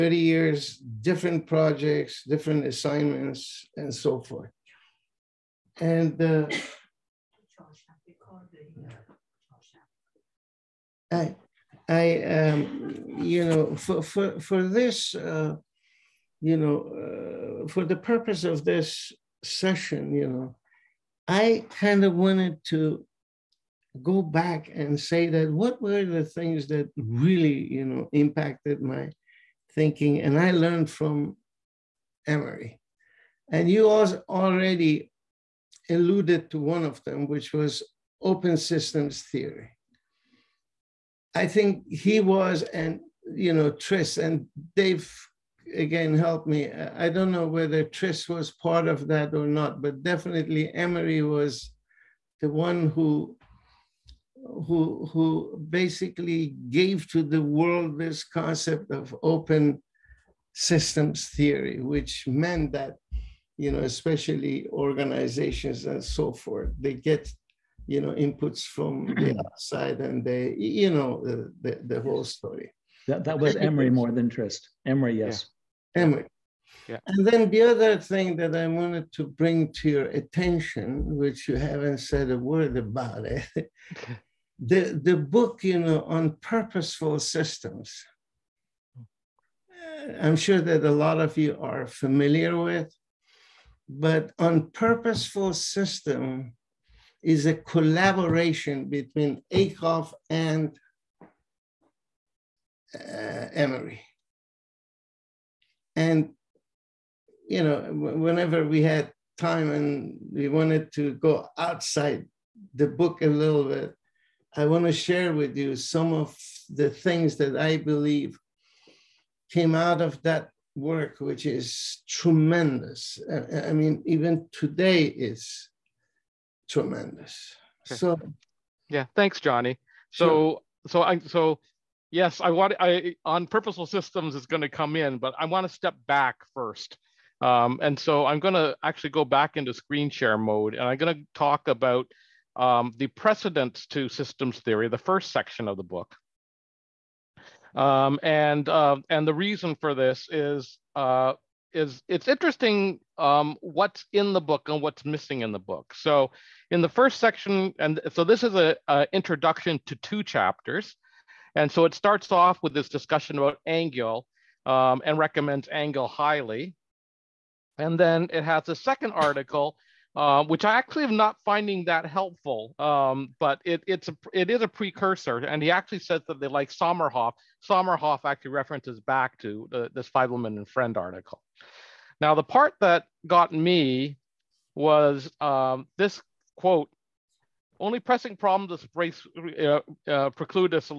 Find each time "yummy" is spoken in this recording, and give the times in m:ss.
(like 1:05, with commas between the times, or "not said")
not said.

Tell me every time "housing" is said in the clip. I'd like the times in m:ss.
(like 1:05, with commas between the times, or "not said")
not said.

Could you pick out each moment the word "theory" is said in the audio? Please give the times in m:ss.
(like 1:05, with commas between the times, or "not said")
0:39, 1:01, 2:24.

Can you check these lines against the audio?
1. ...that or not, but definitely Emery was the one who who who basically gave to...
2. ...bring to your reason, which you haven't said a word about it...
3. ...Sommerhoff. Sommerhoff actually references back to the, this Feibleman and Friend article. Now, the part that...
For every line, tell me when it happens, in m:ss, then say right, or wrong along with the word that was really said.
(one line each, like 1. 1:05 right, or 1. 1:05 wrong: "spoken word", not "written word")
1. 0:49 right
2. 1:19 wrong: "attention", not "reason"
3. 2:56 right.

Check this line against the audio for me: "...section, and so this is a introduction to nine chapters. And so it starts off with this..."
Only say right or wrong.
wrong.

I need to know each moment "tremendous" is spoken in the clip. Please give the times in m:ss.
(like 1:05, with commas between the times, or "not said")
2:02, 2:06.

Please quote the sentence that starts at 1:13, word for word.
That that was Emery more than Trist.